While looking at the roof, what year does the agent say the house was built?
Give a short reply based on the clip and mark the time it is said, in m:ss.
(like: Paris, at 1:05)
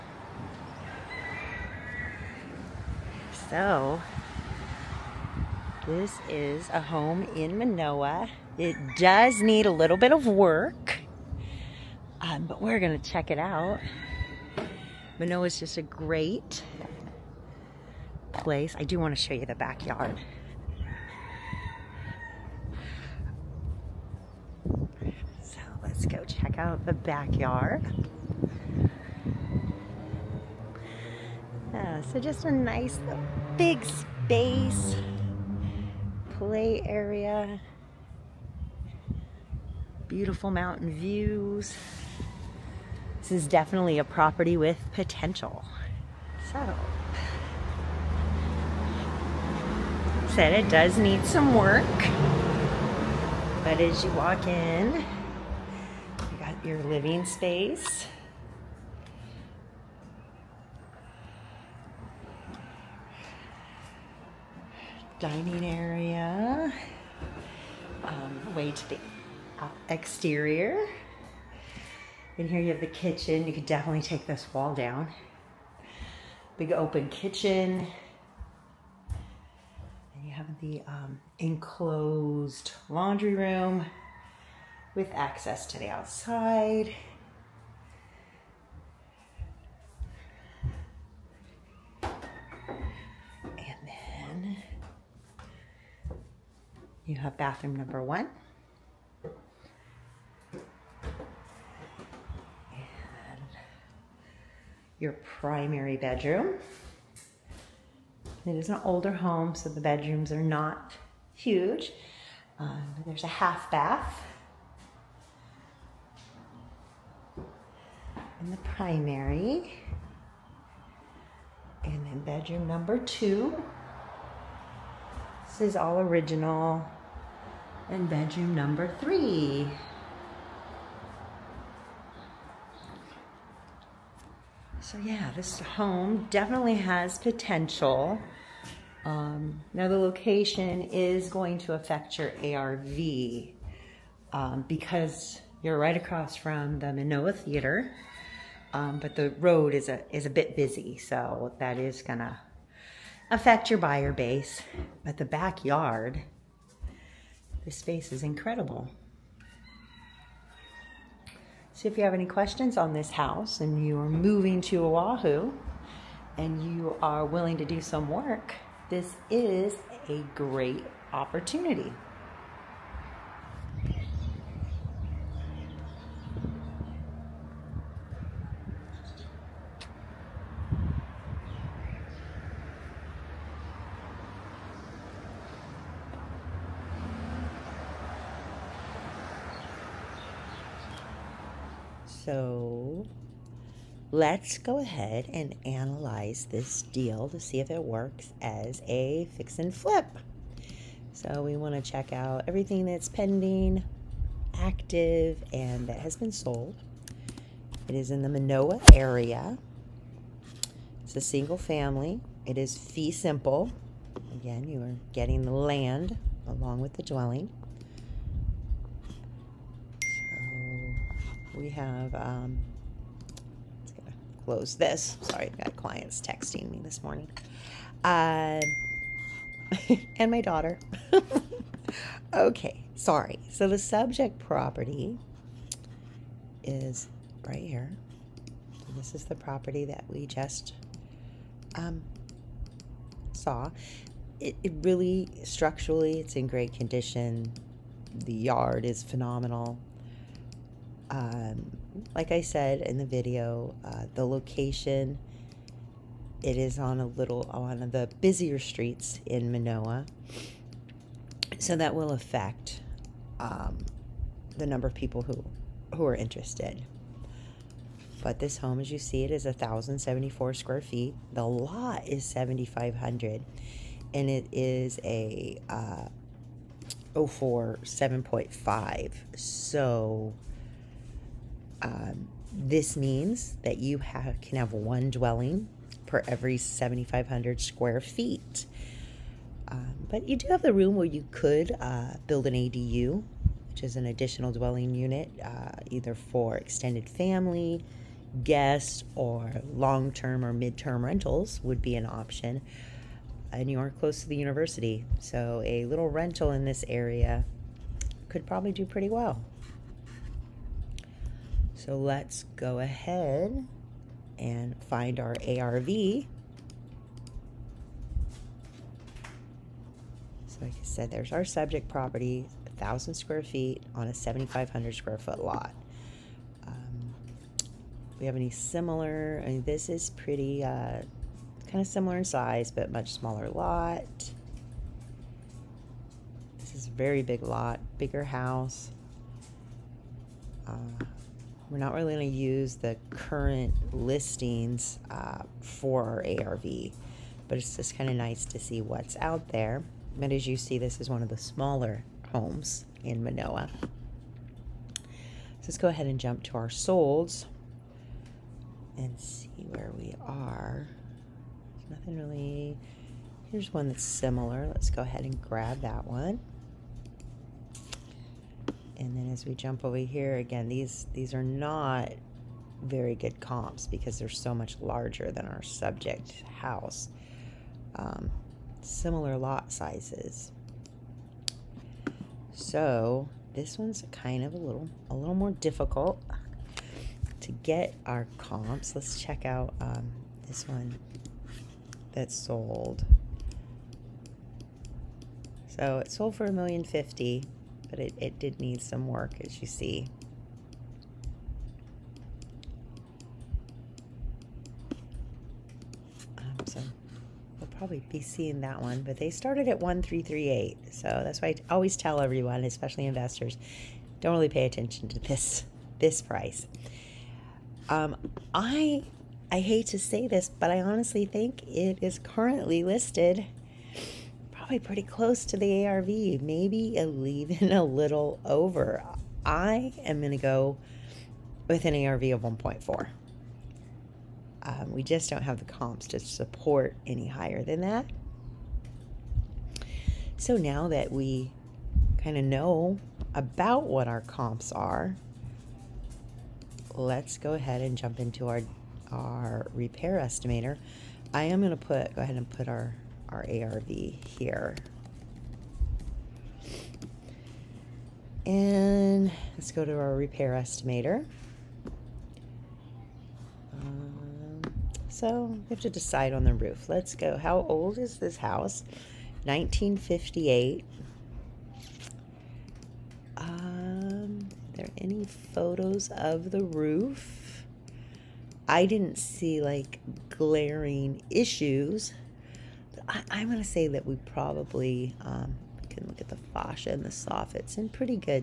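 1958, at 7:49.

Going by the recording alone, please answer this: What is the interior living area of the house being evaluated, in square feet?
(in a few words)
1,074.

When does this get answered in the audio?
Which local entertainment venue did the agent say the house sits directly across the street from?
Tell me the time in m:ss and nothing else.
2:26.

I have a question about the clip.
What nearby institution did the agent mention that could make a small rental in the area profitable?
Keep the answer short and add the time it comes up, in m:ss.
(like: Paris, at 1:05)
the university, at 5:04.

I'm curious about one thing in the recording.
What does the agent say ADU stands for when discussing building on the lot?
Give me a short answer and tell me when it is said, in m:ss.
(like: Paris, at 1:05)
additional dwelling unit, at 4:54.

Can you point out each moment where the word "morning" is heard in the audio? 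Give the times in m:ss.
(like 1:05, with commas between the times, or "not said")
3:47.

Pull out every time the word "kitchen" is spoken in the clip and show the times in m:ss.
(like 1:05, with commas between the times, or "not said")
1:12, 1:17.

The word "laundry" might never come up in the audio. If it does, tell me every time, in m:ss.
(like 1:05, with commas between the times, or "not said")
1:22.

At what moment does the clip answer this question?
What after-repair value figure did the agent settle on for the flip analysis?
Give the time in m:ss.
7:12.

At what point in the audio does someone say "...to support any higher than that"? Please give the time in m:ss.
7:16.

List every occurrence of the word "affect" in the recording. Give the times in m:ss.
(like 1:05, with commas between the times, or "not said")
2:21, 2:33, 4:22.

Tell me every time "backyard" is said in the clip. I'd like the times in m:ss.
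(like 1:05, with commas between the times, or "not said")
0:19, 0:26, 2:35.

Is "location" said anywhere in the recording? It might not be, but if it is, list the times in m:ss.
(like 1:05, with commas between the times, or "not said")
2:19, 4:14.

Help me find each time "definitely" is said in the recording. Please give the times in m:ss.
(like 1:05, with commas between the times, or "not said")
0:43, 1:13, 2:16.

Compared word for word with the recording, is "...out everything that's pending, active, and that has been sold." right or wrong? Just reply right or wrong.
right.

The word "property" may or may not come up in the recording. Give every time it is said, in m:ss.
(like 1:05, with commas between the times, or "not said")
0:44, 3:54, 3:59, 5:21.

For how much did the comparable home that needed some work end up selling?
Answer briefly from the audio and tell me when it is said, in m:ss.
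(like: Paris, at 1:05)
$1,050,000, at 6:36.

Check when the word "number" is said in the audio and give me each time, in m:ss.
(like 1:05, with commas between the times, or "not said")
1:37, 2:02, 2:08, 4:24.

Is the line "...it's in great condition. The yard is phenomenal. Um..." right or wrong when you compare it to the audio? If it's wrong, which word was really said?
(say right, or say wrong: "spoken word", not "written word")
right.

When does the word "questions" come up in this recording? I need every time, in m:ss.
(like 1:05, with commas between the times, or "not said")
2:42.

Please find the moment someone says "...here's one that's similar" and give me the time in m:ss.
6:03.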